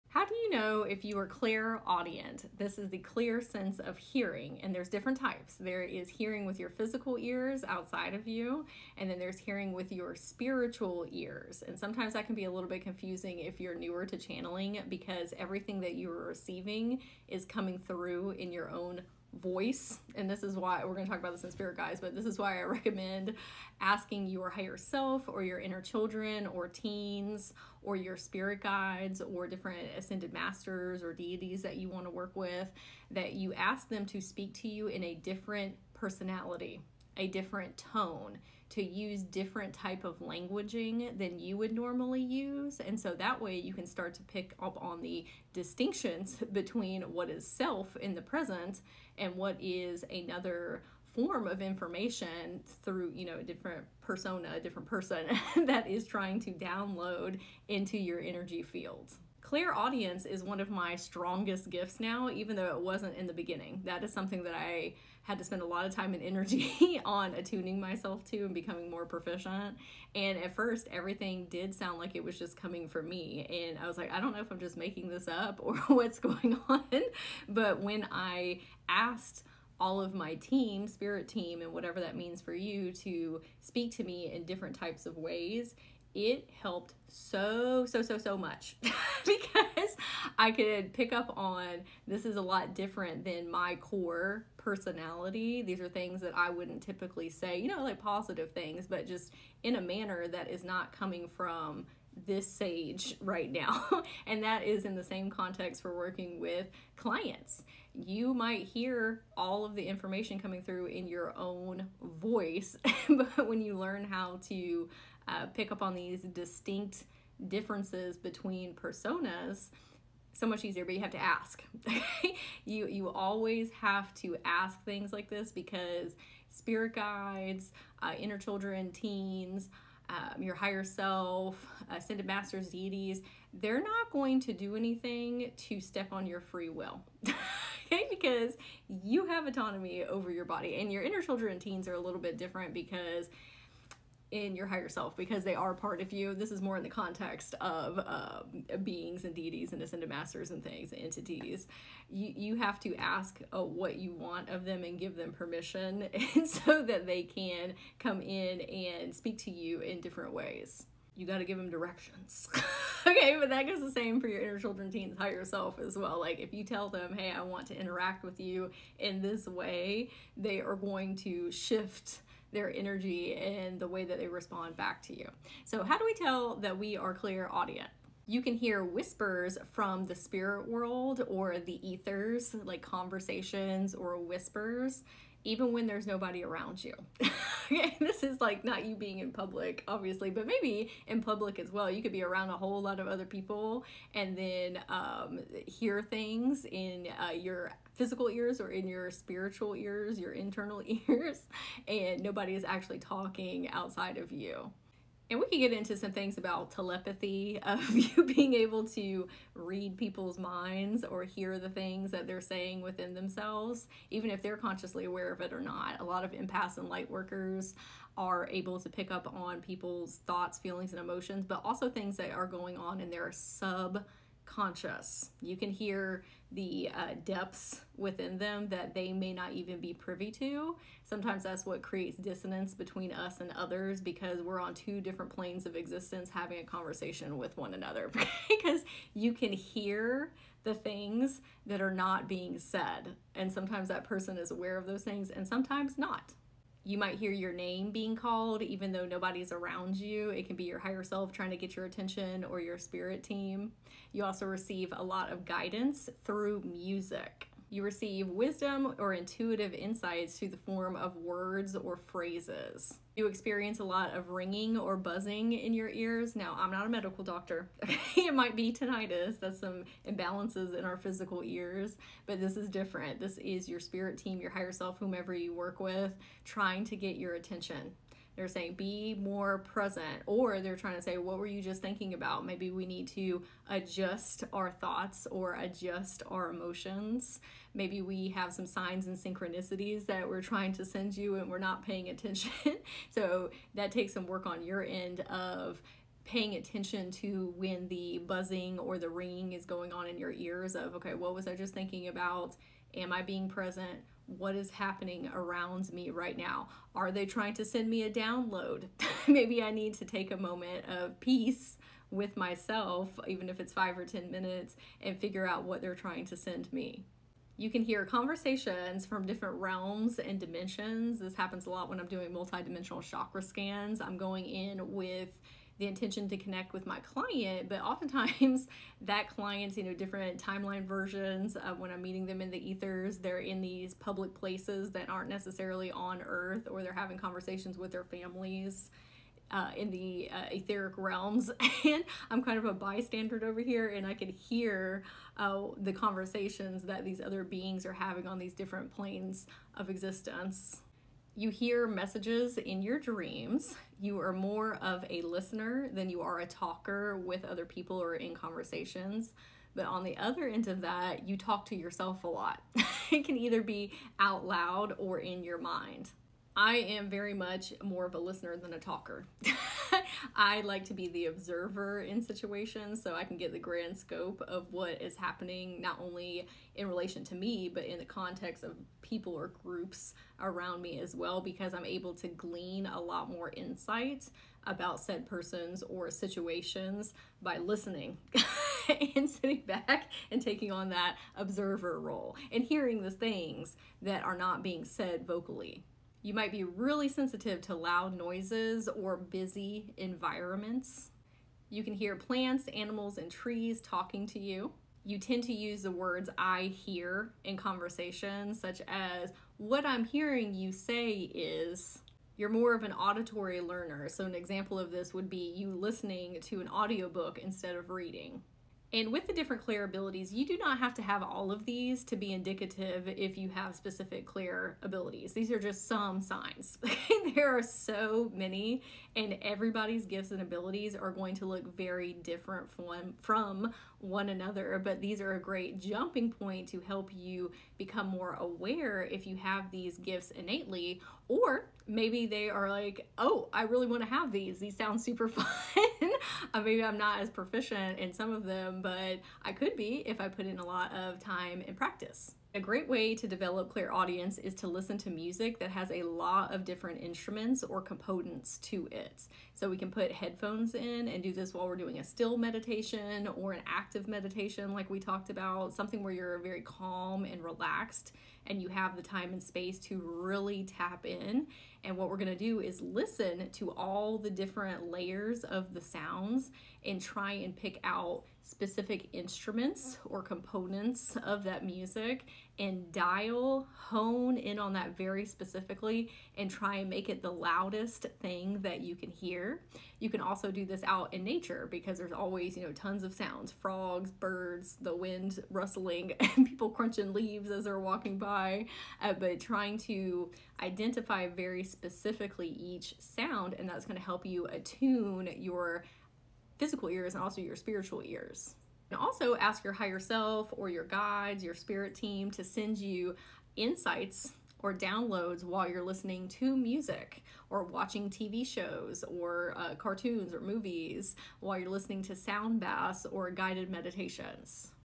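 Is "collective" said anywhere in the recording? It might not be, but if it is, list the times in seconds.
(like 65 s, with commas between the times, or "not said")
not said.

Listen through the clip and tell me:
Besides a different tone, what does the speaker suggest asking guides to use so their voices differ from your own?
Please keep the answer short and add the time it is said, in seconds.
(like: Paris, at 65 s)
a different personality, at 35 s.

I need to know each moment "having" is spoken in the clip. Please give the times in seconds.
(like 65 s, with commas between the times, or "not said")
236 s, 336 s, 347 s.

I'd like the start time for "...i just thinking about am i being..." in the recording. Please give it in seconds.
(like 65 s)
301 s.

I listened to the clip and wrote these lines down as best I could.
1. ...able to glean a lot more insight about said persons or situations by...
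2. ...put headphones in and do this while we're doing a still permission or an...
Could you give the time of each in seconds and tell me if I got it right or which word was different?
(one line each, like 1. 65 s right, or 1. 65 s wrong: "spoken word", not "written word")
1. 381 s right
2. 459 s wrong: "meditation", not "permission".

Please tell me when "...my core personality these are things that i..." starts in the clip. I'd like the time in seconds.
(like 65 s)
93 s.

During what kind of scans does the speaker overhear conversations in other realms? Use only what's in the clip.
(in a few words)
multidimensional chakra scans.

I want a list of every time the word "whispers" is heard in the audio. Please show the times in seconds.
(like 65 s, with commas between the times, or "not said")
178 s, 184 s.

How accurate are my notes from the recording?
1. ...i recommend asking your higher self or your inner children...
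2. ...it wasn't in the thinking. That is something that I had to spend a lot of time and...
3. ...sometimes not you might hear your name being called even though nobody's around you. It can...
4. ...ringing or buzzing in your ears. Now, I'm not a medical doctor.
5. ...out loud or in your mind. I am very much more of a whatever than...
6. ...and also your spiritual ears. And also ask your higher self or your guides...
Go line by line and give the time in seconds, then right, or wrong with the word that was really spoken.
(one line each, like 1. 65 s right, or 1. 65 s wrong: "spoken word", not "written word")
1. 22 s right
2. 62 s wrong: "beginning", not "thinking"
3. 245 s right
4. 264 s right
5. 364 s wrong: "listener", not "whatever"
6. 507 s right.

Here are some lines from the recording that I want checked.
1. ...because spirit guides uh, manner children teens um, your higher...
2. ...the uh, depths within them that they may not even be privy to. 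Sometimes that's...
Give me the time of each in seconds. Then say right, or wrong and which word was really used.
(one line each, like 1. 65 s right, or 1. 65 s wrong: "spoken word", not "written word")
1. 125 s wrong: "inner", not "manner"
2. 226 s right.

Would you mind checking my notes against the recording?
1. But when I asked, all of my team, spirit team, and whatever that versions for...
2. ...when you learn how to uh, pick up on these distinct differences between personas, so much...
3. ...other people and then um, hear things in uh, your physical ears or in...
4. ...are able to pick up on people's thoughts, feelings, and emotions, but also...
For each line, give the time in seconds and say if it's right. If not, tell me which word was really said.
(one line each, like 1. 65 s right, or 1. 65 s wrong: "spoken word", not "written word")
1. 77 s wrong: "means", not "versions"
2. 113 s right
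3. 193 s right
4. 218 s right.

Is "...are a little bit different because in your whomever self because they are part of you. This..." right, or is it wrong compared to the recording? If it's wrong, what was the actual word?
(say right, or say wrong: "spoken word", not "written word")
wrong: "higher", not "whomever".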